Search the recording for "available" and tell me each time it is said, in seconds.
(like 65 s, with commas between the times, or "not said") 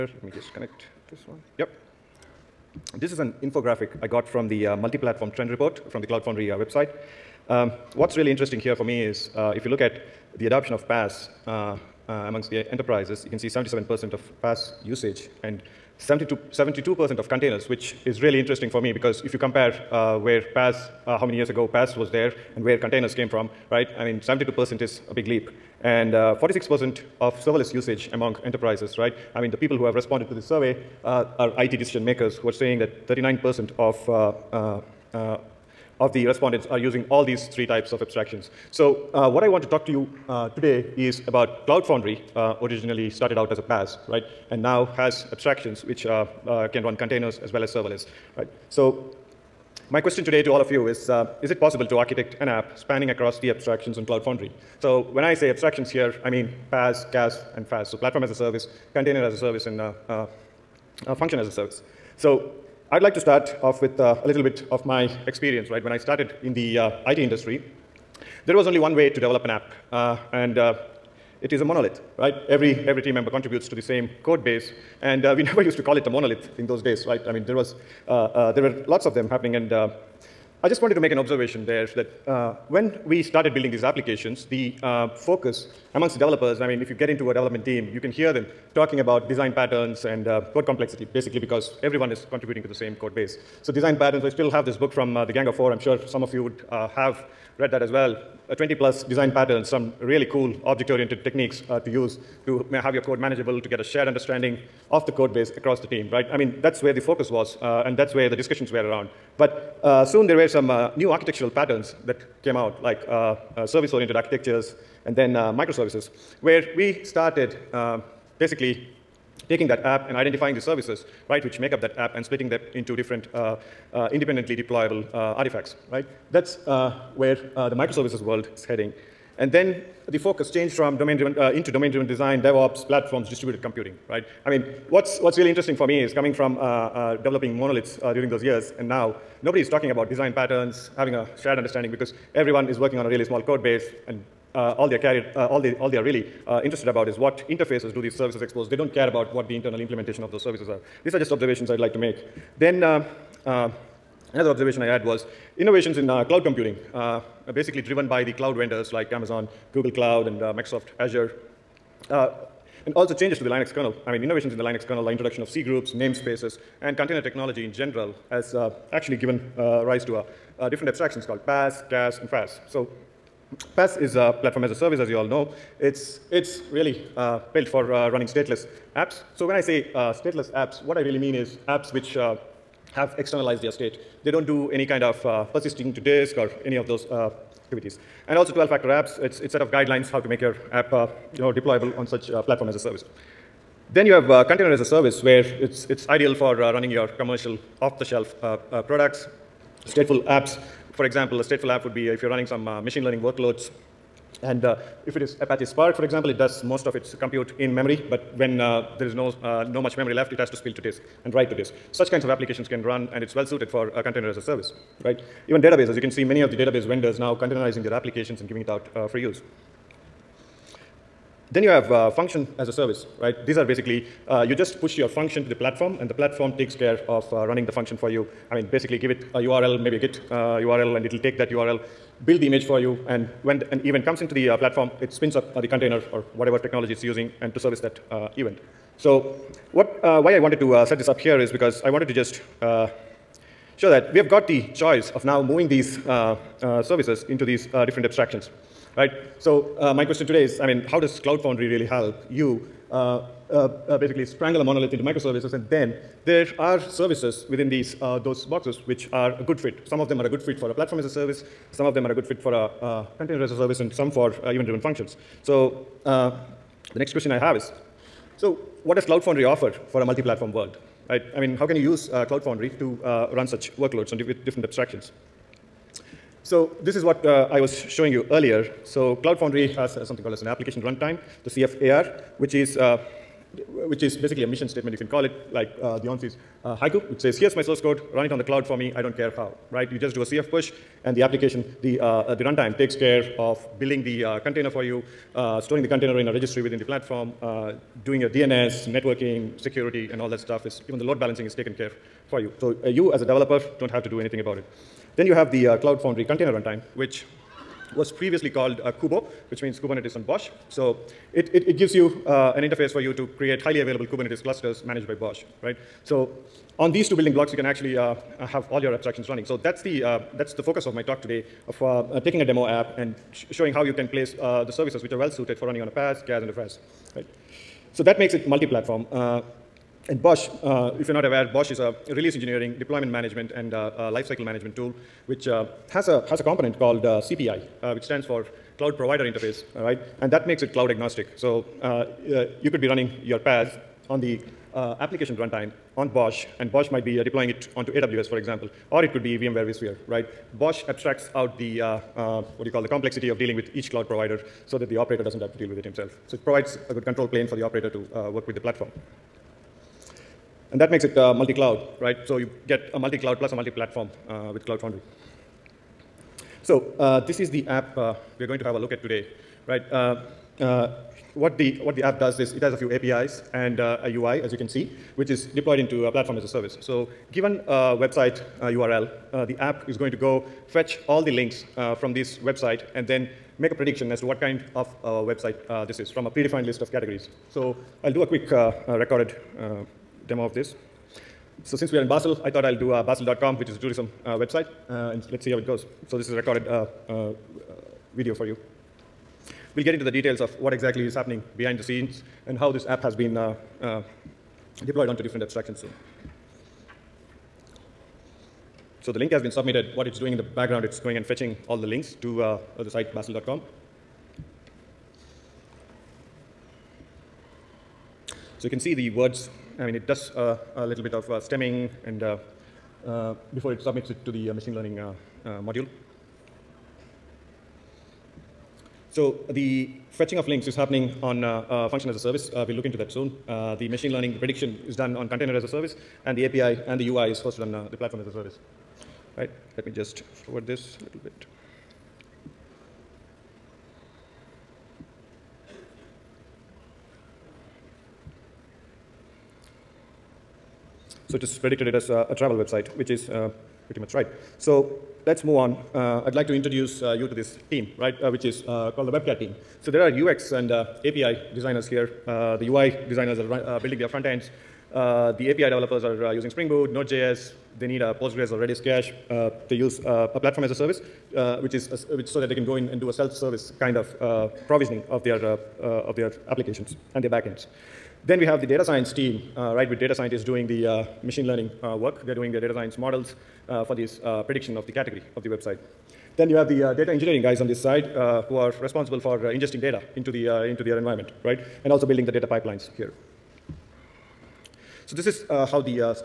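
313 s.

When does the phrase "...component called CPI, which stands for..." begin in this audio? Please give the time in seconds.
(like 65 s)
336 s.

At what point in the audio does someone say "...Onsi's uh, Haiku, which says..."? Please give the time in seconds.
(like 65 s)
286 s.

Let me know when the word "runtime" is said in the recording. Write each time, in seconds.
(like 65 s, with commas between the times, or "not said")
280 s, 292 s, 306 s, 345 s.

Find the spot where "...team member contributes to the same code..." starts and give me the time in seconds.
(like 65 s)
73 s.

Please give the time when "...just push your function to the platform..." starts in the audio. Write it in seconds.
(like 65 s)
224 s.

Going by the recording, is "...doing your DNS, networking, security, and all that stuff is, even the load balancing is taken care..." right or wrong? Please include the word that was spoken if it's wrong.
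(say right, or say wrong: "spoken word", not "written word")
right.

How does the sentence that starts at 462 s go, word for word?
Uh, the UI designers are uh, building their front ends.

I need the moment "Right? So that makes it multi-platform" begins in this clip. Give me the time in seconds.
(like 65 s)
327 s.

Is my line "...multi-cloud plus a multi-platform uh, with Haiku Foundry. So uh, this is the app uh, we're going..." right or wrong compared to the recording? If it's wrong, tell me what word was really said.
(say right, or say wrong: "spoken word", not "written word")
wrong: "Cloud", not "Haiku".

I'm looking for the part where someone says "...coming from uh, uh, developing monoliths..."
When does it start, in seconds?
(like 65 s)
136 s.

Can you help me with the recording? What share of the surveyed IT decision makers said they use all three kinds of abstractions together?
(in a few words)
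39%.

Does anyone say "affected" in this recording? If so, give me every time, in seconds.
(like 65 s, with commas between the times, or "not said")
not said.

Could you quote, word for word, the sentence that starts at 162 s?
Uh, and also changes to the Linux kernel.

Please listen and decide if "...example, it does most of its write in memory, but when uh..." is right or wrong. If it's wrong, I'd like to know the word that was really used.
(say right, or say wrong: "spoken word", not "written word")
wrong: "compute", not "write".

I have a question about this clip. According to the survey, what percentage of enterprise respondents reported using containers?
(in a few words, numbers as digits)
72%.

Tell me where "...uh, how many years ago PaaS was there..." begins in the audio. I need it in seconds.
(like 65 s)
21 s.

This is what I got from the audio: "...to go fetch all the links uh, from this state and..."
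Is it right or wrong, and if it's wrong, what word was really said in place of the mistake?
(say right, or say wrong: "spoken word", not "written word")
wrong: "website", not "state".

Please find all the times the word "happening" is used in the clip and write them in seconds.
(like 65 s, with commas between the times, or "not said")
79 s, 401 s, 430 s.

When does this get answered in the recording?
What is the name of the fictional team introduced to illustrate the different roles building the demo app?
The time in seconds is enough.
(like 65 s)
459 s.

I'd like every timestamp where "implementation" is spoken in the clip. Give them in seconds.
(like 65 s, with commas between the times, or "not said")
149 s.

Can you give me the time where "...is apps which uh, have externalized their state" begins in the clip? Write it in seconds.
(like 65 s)
181 s.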